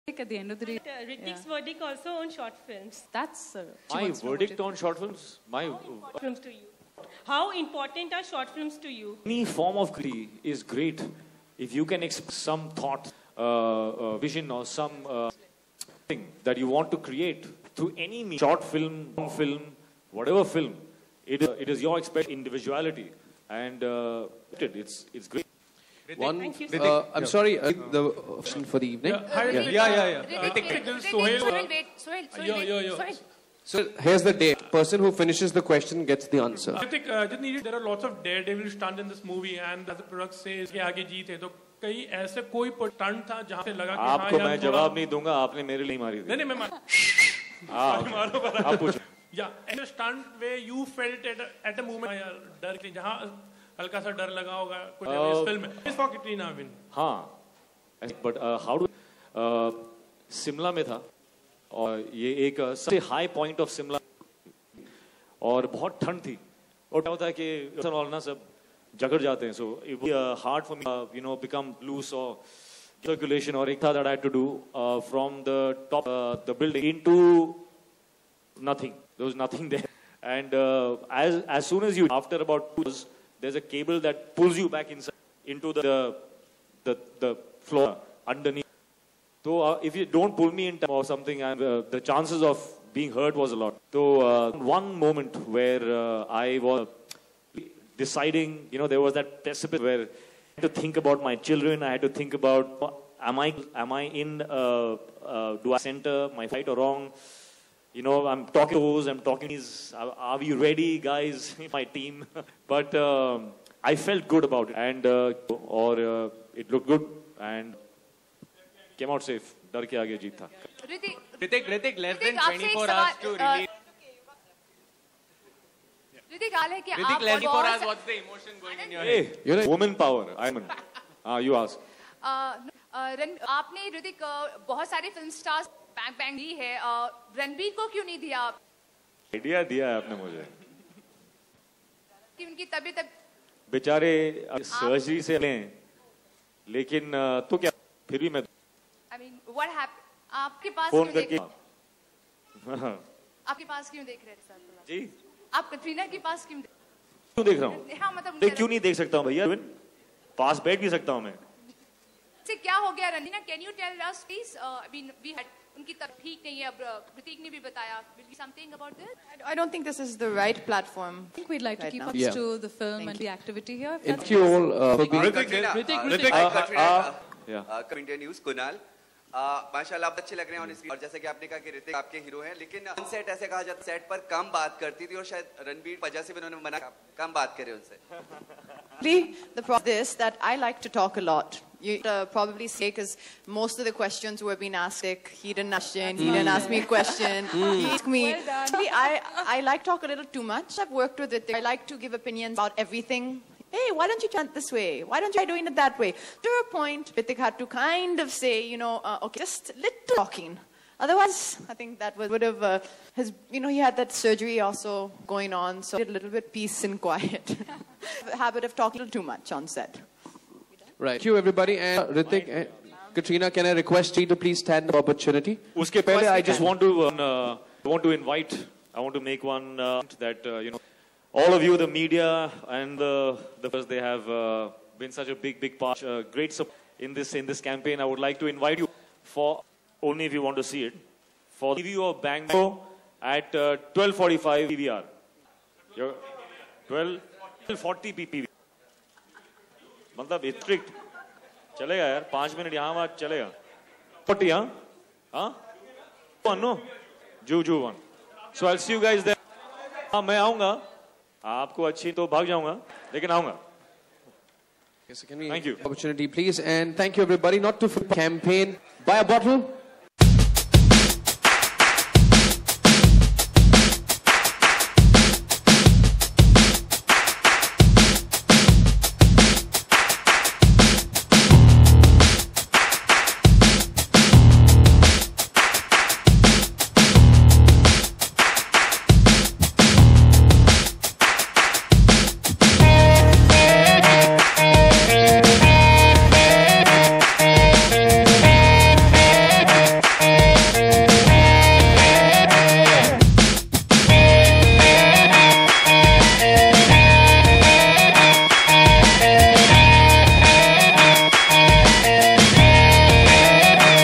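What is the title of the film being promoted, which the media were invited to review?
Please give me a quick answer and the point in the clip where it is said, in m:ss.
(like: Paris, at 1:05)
Bang Bang, at 4:02.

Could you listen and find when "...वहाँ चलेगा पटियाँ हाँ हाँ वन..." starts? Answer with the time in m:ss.
4:12.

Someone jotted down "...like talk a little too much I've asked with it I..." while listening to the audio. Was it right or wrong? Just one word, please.
wrong.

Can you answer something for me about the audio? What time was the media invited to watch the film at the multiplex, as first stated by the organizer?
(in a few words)
12:45.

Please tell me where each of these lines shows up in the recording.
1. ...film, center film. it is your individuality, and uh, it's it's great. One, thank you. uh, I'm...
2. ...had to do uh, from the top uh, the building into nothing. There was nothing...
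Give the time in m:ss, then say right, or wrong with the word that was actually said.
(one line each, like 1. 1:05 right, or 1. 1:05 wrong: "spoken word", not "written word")
1. 0:19 wrong: "whatever", not "center"
2. 1:14 right.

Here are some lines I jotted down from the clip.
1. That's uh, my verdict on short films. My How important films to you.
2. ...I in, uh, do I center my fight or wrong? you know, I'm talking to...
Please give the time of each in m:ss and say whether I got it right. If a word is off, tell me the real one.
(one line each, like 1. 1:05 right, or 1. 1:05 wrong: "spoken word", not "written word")
1. 0:03 right
2. 1:43 right.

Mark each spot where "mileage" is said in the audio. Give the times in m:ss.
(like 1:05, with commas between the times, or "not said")
not said.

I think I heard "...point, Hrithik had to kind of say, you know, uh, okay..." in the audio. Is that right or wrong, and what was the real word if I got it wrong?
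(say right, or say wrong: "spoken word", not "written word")
right.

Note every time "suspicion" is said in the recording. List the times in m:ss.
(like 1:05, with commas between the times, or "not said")
not said.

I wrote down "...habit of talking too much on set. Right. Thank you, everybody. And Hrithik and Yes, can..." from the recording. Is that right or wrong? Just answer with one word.
wrong.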